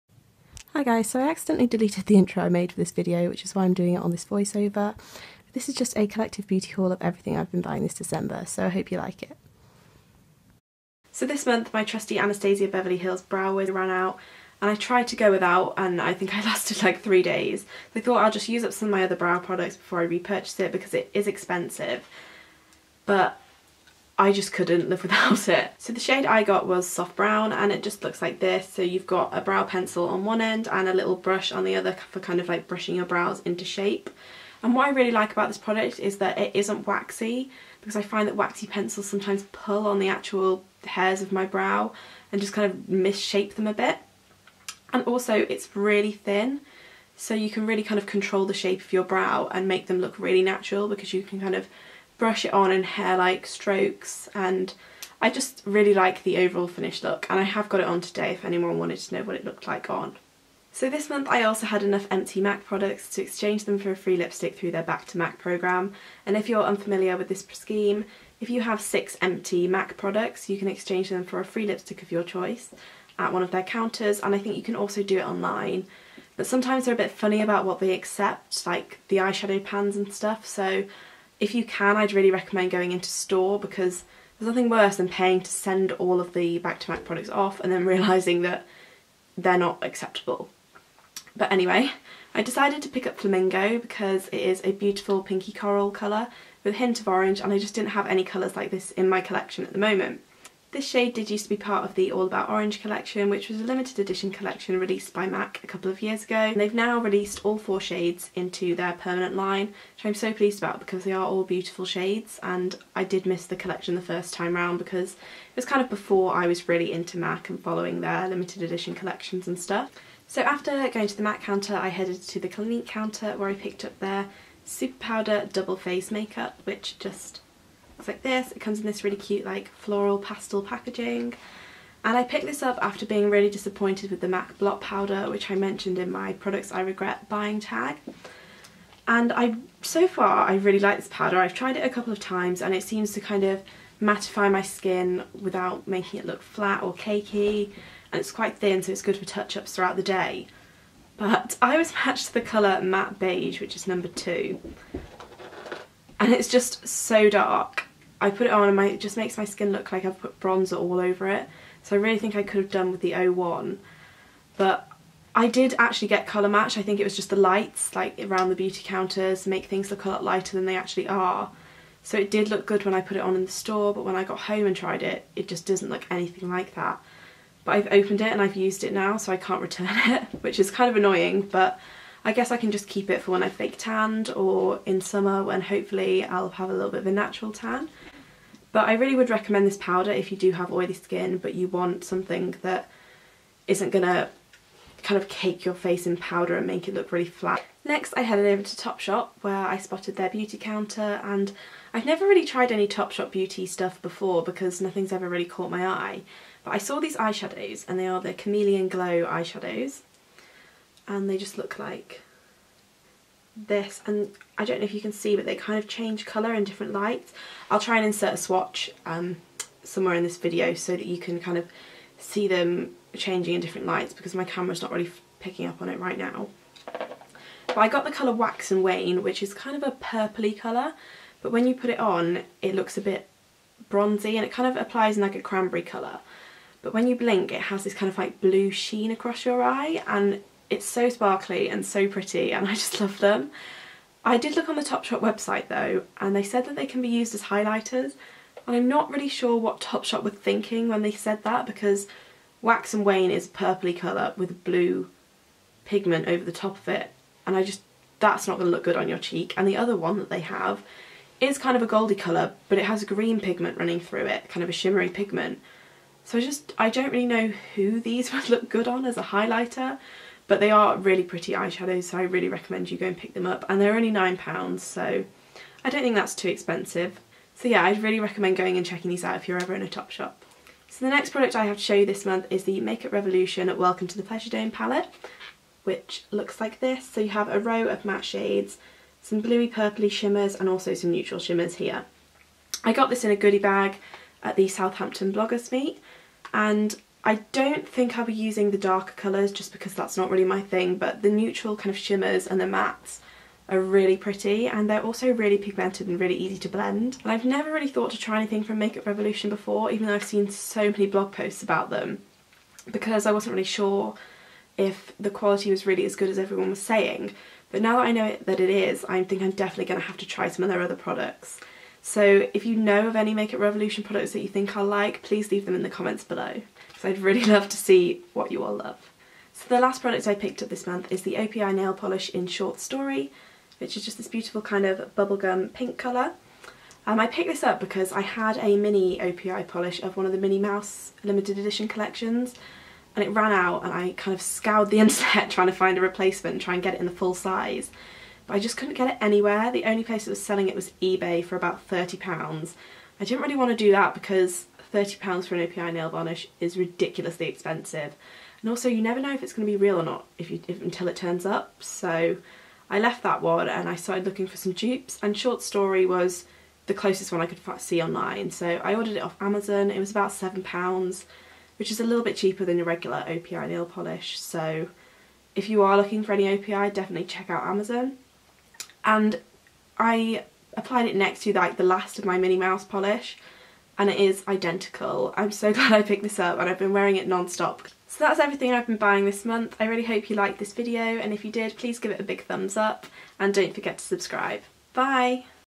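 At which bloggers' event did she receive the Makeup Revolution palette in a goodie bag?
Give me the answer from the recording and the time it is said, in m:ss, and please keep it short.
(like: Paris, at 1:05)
Southampton Bloggers Meet, at 4:54.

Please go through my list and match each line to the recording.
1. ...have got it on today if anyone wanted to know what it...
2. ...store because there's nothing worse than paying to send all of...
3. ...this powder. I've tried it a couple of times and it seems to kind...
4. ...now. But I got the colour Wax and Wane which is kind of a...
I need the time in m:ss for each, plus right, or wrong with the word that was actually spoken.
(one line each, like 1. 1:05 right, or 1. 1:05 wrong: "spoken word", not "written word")
1. 0:57 right
2. 1:23 right
3. 2:20 right
4. 3:46 right.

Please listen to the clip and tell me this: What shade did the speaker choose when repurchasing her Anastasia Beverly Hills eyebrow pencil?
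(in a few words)
Soft brown.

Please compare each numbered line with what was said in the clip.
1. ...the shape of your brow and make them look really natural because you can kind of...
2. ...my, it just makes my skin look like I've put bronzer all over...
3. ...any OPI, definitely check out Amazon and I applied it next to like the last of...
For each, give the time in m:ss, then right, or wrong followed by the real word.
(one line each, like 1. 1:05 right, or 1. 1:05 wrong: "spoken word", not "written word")
1. 0:48 right
2. 2:38 right
3. 6:16 right.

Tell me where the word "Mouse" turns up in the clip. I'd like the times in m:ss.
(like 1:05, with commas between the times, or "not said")
5:40, 6:22.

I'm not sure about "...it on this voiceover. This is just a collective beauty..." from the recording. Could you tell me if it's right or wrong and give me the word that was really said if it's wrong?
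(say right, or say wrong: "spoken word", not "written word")
right.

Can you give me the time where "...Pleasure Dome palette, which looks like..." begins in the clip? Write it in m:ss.
4:44.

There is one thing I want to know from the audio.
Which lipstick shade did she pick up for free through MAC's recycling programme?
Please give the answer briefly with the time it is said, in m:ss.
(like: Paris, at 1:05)
Flamingo, at 1:33.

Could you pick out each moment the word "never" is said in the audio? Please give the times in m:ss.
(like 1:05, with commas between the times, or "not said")
3:22, 5:07, 5:59.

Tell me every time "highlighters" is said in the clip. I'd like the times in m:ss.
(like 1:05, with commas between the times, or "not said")
4:07, 4:29.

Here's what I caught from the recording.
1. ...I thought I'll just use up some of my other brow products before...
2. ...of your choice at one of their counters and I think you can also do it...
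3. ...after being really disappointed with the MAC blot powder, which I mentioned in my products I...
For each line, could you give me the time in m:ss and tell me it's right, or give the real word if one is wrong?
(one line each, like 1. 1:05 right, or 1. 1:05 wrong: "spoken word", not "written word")
1. 0:17 right
2. 1:12 right
3. 2:12 right.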